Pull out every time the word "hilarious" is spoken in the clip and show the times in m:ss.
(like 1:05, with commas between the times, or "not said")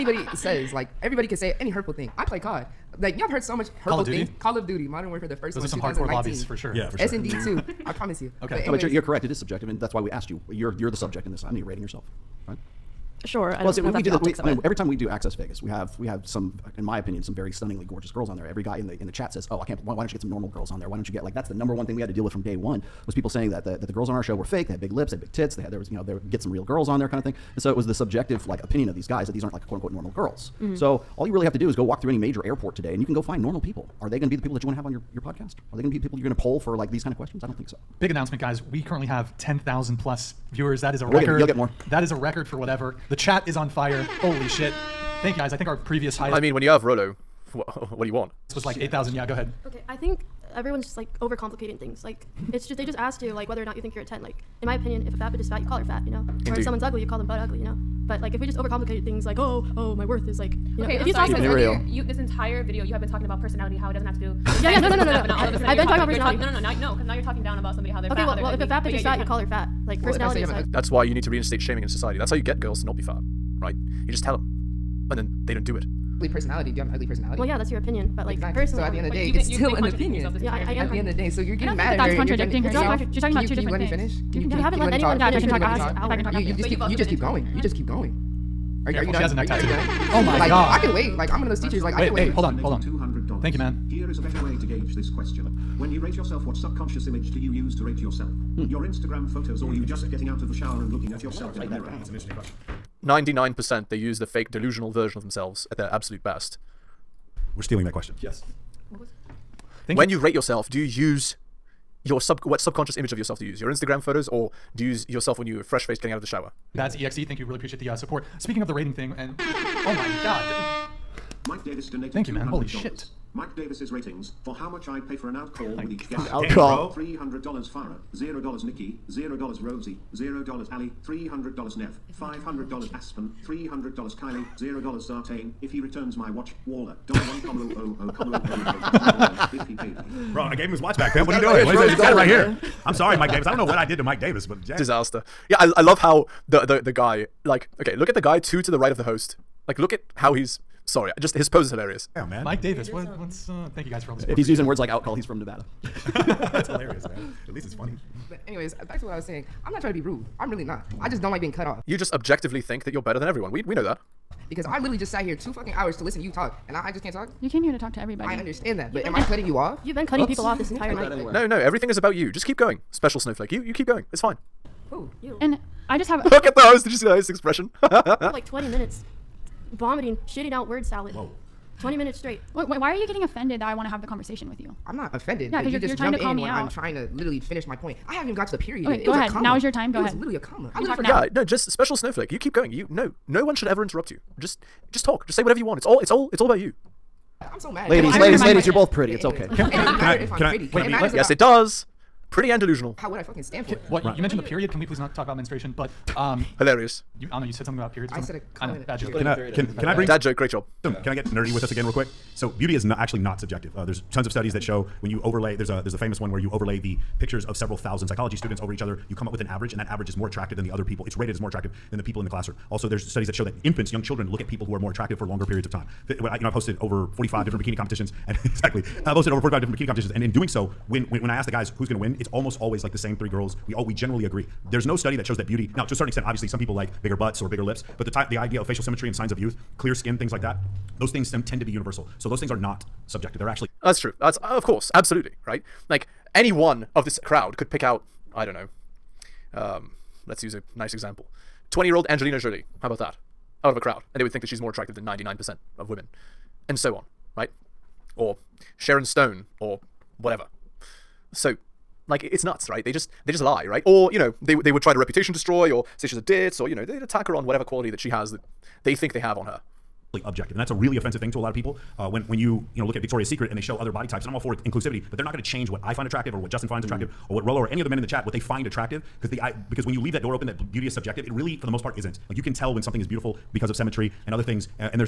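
2:31, 2:36, 3:26.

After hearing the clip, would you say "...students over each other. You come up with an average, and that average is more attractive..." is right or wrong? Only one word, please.
right.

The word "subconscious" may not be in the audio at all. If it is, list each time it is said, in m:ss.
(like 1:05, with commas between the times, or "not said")
1:36, 1:52.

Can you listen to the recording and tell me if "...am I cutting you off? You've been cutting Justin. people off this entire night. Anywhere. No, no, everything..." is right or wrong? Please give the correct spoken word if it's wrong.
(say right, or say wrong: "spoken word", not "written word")
wrong: "Oops", not "Justin".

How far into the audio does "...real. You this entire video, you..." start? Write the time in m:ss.
1:01.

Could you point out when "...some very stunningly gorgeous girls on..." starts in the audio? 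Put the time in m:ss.
0:17.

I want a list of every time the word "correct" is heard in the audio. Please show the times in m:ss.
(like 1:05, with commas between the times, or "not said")
0:09.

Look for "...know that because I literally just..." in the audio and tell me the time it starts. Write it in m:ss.
2:43.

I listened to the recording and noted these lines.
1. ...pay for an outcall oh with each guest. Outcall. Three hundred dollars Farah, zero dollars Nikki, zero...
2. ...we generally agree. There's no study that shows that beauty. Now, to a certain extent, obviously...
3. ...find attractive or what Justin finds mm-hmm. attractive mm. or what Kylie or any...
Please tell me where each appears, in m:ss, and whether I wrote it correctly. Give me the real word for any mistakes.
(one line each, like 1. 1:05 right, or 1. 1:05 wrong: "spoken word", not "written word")
1. 2:05 right
2. 3:53 right
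3. 4:35 wrong: "Rollo", not "Kylie".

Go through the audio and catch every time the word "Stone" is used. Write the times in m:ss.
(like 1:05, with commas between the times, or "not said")
4:19.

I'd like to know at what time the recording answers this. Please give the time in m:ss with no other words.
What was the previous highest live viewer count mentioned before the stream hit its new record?
0:48.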